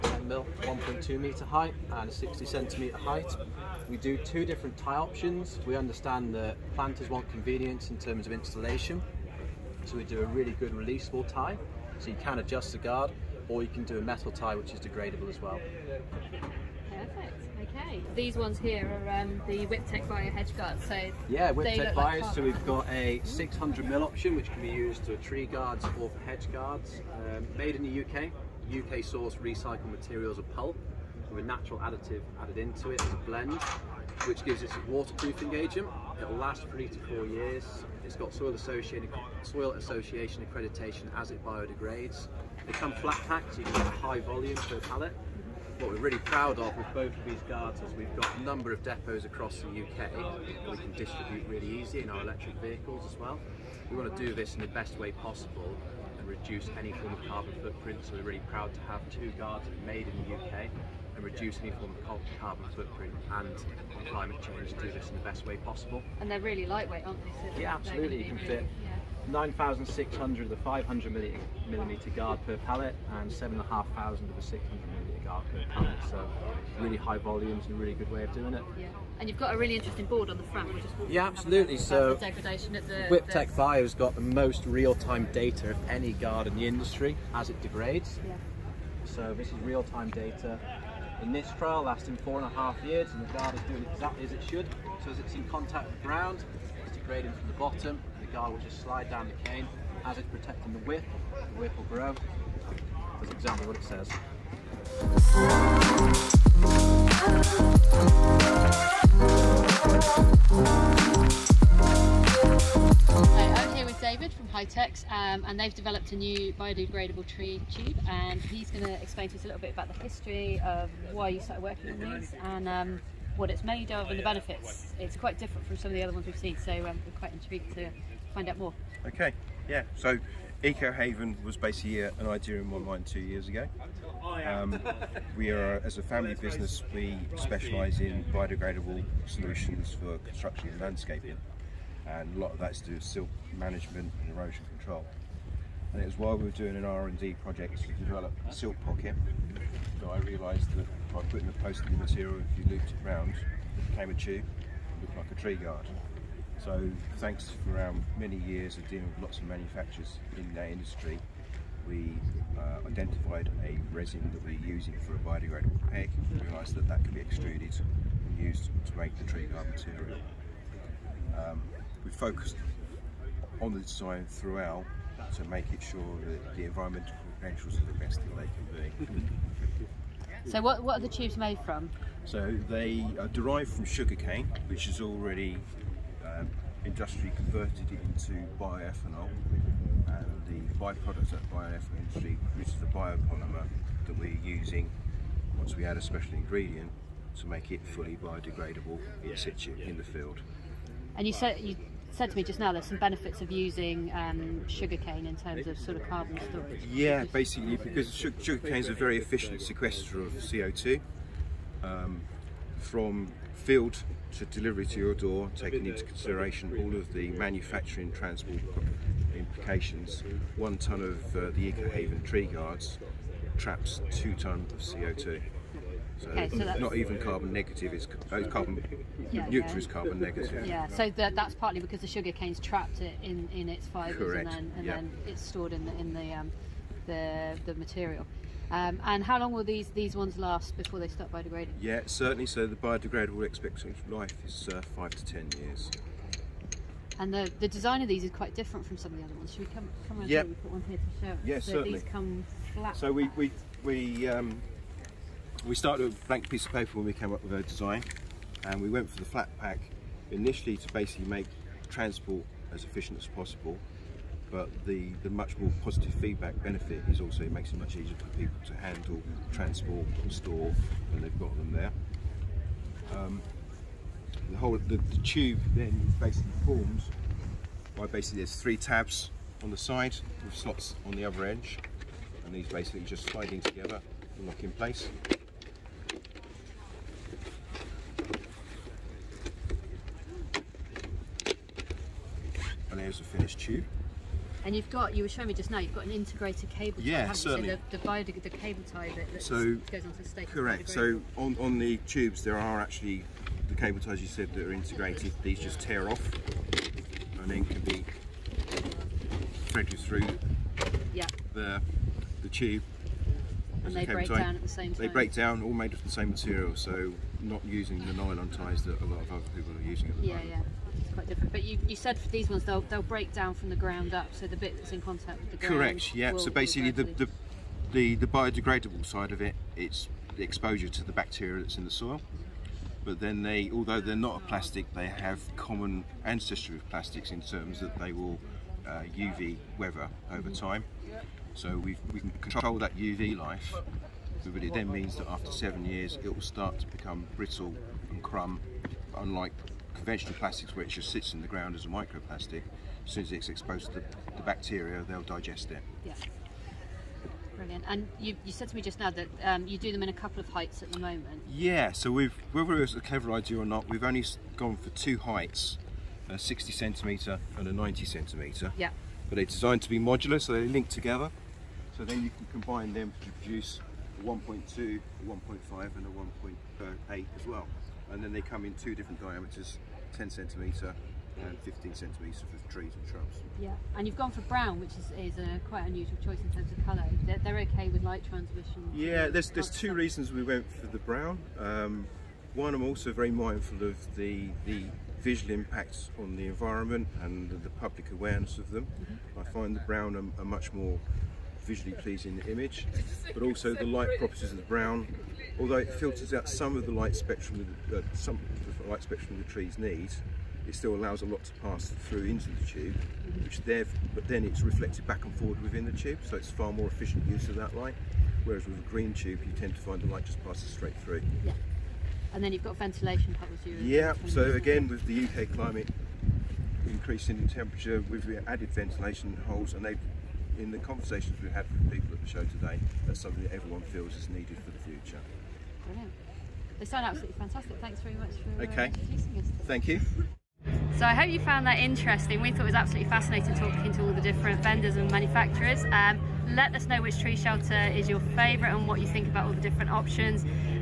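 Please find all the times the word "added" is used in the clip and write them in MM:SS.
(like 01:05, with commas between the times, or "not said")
00:32, 07:08.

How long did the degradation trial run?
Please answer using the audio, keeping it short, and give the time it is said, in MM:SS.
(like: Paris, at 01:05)
4.5 years, at 01:32.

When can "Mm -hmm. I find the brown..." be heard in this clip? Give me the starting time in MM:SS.
06:38.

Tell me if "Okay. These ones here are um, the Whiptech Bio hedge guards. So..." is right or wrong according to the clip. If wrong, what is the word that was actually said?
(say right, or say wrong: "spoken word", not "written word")
right.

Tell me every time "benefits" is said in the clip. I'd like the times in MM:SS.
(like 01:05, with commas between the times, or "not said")
02:04, 03:22, 04:26.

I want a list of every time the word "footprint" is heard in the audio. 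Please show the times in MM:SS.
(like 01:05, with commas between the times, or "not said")
00:57, 01:02.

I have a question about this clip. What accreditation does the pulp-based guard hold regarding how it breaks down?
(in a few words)
Soil Association.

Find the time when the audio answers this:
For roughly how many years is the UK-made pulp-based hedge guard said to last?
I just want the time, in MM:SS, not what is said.
00:36.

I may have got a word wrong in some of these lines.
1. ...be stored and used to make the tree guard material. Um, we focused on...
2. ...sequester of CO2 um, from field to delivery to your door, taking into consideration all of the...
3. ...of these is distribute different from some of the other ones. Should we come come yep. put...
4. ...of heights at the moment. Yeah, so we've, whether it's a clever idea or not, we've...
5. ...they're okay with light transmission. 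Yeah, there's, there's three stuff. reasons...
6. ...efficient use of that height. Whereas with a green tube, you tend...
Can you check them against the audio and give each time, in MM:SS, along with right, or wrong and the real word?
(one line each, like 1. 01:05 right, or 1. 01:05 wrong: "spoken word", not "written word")
1. 02:47 wrong: "extruded", not "stored"
2. 03:29 right
3. 04:08 wrong: "quite", not "distribute"
4. 06:00 right
5. 06:27 wrong: "two", not "three"
6. 06:56 wrong: "light", not "height".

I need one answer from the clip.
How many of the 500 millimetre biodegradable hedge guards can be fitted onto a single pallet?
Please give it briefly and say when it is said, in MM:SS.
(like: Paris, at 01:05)
9,600, at 01:09.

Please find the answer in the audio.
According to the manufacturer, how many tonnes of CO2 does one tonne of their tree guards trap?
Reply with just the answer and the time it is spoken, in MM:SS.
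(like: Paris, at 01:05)
2 tonnes, at 03:44.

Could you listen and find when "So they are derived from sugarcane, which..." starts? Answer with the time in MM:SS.
03:02.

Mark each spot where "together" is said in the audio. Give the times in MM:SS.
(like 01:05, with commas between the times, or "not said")
04:43, 06:10.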